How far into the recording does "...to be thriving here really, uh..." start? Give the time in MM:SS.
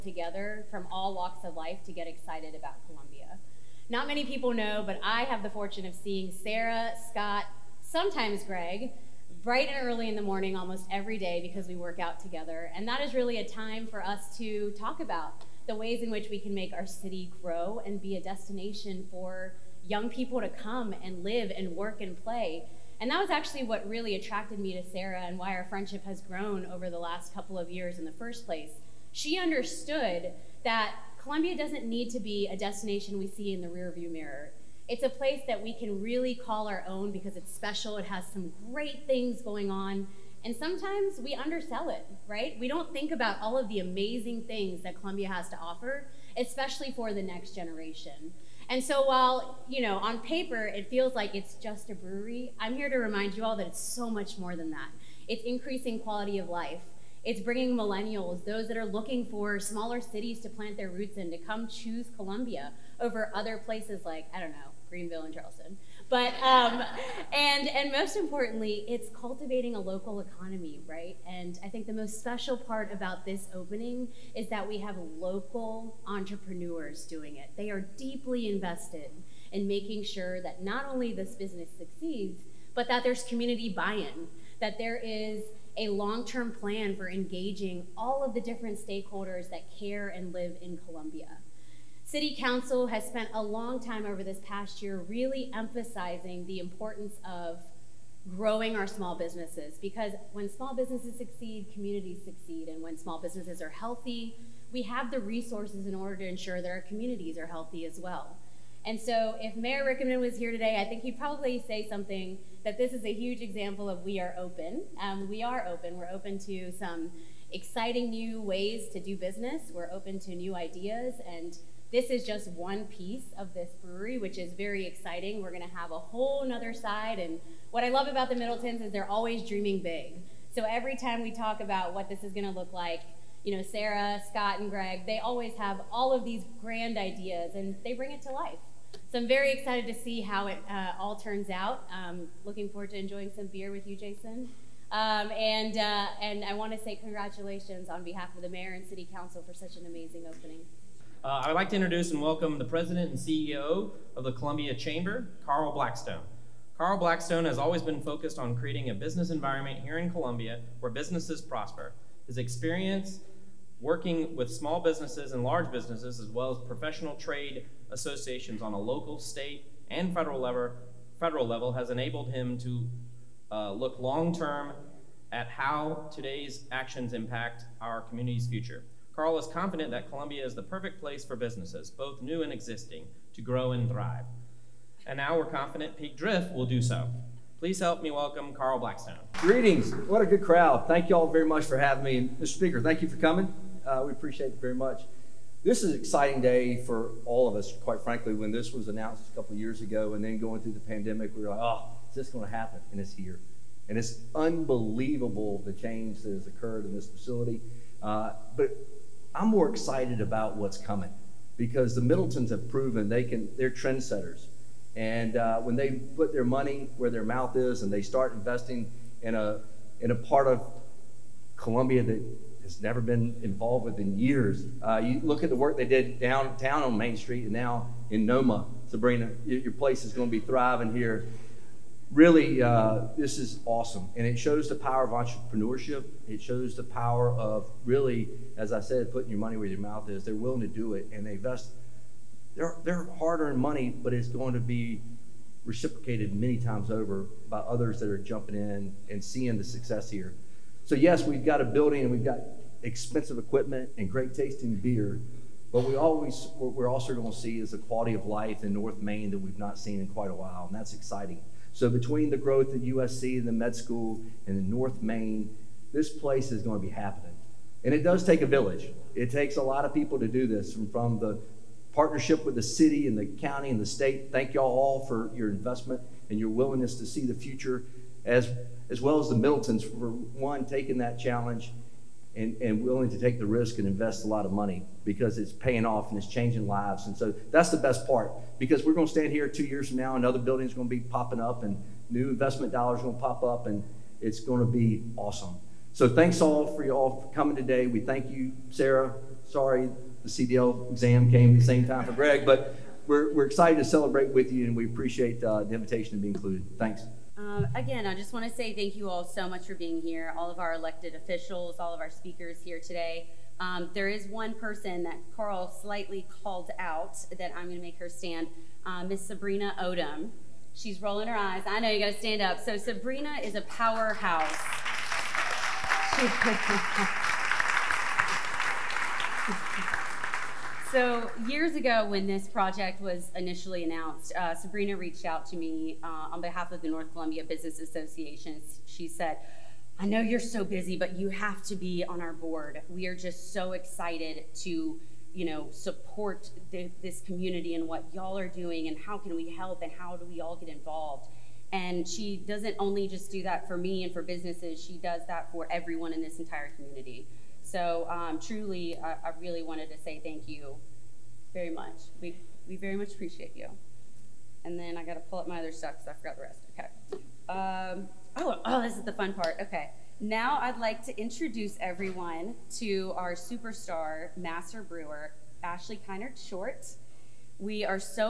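03:50.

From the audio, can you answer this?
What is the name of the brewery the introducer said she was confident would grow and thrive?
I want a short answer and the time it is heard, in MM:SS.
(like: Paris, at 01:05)
Peak Drift, at 03:05.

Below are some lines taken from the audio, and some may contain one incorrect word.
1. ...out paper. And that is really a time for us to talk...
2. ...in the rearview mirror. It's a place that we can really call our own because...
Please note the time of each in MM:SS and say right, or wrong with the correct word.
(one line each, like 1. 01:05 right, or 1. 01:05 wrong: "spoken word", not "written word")
1. 00:11 wrong: "together", not "paper"
2. 00:33 right.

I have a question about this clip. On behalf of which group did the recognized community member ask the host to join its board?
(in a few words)
North Columbia Business Association.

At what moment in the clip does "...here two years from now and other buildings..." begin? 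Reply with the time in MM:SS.
04:49.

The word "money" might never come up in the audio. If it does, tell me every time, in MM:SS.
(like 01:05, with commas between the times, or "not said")
03:36, 03:59, 04:03, 04:44.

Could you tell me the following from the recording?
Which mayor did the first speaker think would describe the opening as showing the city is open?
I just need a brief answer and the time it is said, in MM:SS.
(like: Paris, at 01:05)
Mayor Rickenmann, at 01:49.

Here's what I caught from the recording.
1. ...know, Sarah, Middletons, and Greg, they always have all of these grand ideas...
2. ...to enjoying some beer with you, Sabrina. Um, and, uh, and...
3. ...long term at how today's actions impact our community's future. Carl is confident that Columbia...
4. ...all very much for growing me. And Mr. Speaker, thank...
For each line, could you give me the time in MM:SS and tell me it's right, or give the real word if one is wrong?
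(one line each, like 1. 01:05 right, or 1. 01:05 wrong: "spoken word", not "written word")
1. 02:13 wrong: "Scott", not "Middletons"
2. 02:22 wrong: "Jason", not "Sabrina"
3. 02:53 right
4. 03:11 wrong: "having", not "growing".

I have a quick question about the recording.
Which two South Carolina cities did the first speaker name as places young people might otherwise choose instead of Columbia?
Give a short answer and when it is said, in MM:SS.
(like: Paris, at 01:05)
Greenville and Charleston, at 01:04.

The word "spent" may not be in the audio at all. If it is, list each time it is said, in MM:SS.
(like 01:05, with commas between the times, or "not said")
01:33.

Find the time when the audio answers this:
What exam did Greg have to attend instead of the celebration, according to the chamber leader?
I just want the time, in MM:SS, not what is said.
05:00.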